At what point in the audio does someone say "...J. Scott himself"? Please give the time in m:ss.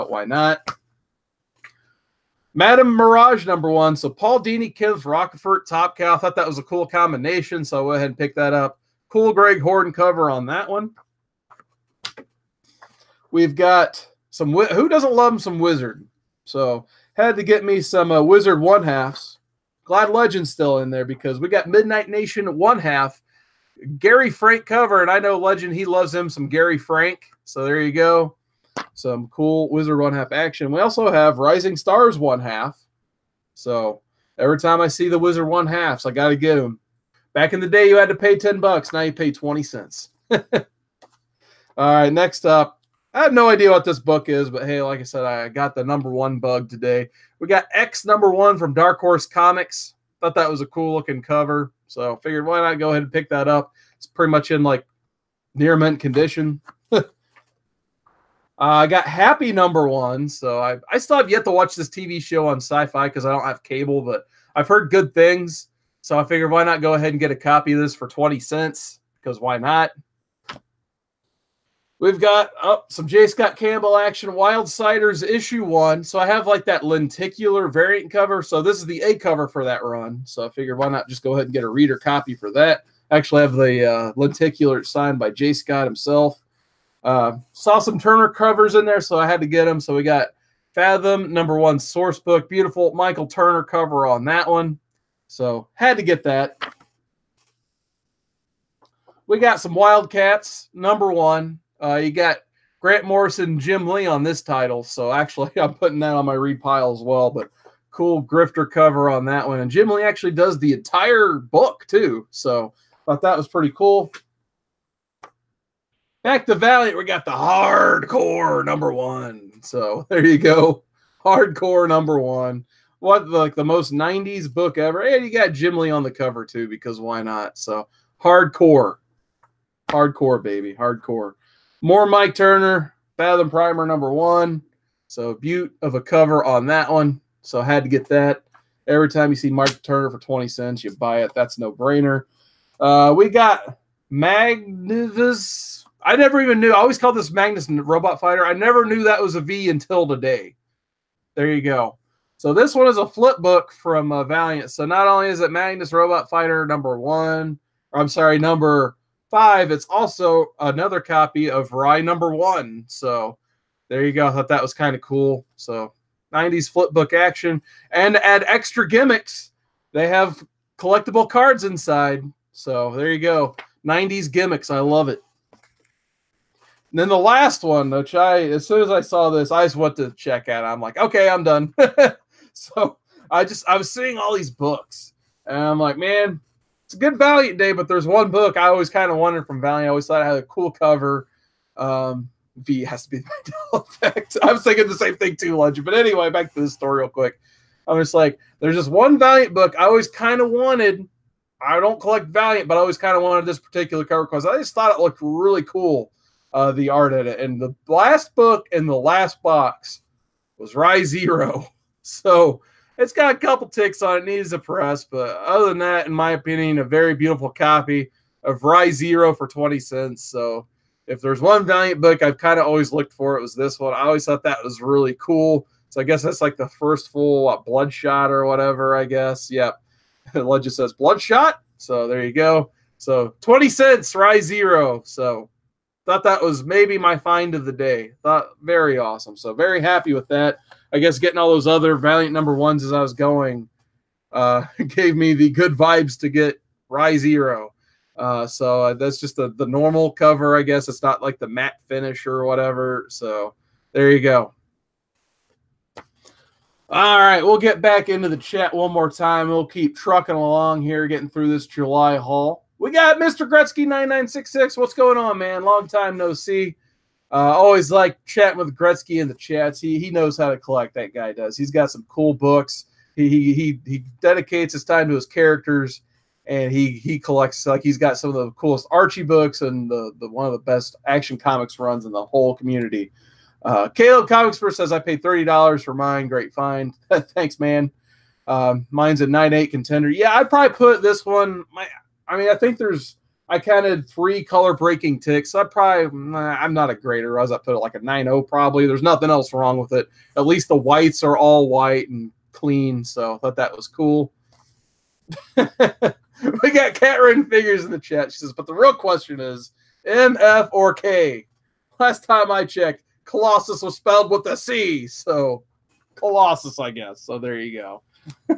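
1:25.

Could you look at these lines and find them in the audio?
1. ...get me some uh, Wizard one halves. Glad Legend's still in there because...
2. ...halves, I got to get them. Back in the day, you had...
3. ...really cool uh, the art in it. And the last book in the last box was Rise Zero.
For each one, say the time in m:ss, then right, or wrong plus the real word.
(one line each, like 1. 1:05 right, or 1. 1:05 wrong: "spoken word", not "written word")
1. 0:17 right
2. 0:35 right
3. 3:25 right.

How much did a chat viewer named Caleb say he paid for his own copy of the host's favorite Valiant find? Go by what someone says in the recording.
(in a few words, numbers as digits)
$30.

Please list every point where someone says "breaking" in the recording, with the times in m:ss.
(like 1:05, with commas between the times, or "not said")
4:54.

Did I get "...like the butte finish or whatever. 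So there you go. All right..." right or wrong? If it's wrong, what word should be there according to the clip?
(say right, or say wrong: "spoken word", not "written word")
wrong: "matte", not "butte".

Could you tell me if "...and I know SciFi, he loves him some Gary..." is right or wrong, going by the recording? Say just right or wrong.
wrong.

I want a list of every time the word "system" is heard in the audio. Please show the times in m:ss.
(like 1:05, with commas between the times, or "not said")
not said.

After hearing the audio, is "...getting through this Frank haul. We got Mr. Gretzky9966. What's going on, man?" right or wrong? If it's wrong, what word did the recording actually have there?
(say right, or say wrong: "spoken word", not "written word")
wrong: "July", not "Frank".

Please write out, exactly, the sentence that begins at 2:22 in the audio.
Uh, we got Magnus I never even knew.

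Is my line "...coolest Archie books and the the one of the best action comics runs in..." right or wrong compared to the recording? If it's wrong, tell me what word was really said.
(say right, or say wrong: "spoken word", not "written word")
right.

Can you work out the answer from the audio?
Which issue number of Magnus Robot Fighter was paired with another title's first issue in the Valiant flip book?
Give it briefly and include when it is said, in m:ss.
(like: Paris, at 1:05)
5, at 2:38.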